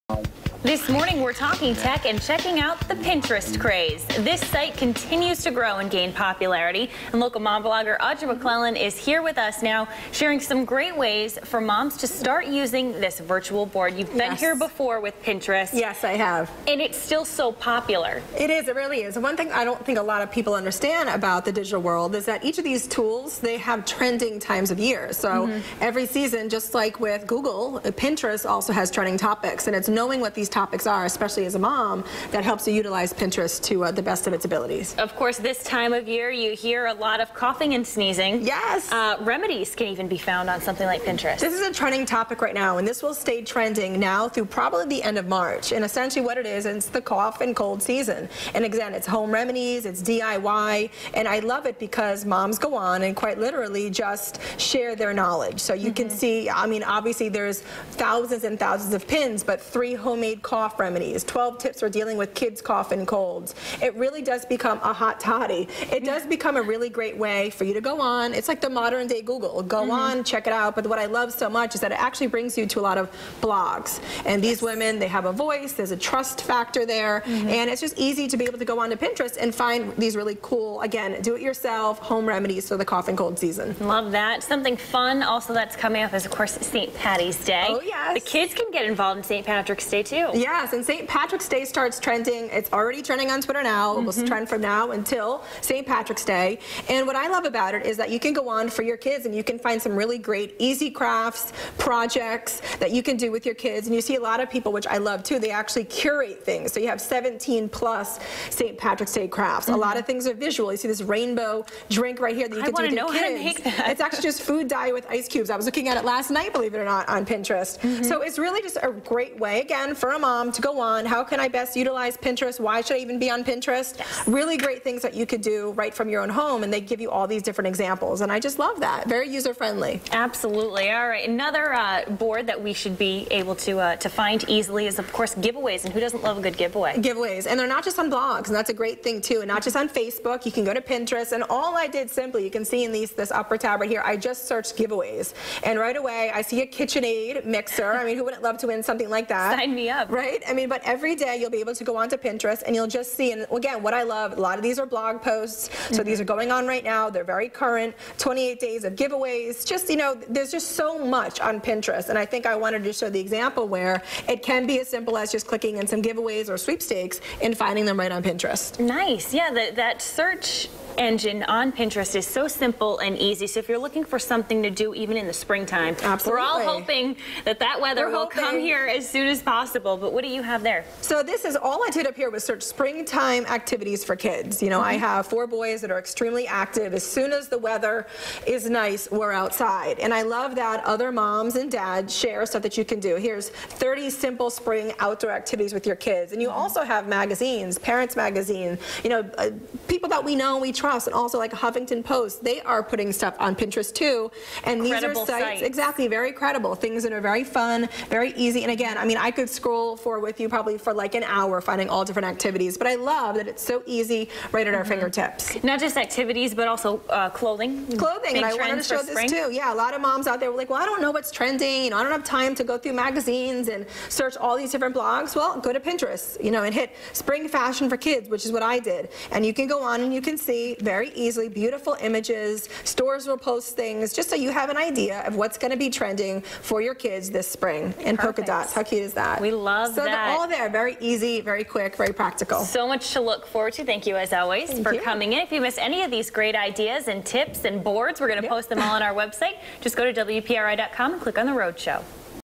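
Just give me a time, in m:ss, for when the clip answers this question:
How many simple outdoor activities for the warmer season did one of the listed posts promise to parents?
3:13.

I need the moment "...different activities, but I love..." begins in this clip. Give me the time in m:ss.
3:32.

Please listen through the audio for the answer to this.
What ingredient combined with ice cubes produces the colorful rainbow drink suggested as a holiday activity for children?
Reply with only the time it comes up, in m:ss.
1:54.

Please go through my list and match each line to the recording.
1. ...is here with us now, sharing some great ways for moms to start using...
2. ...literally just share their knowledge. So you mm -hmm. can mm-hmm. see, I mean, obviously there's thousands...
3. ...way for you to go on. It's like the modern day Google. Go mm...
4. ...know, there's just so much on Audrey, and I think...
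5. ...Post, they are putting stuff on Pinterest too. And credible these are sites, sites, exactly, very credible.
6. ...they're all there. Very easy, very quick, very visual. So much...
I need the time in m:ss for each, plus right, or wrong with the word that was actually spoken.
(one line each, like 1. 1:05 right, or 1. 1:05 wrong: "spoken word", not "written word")
1. 0:08 right
2. 0:53 right
3. 1:07 right
4. 2:40 wrong: "Pinterest", not "Audrey"
5. 3:22 right
6. 4:00 wrong: "practical", not "visual".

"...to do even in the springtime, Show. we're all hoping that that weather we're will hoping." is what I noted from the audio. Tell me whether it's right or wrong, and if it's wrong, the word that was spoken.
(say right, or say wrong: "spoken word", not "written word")
wrong: "Absolutely", not "Show".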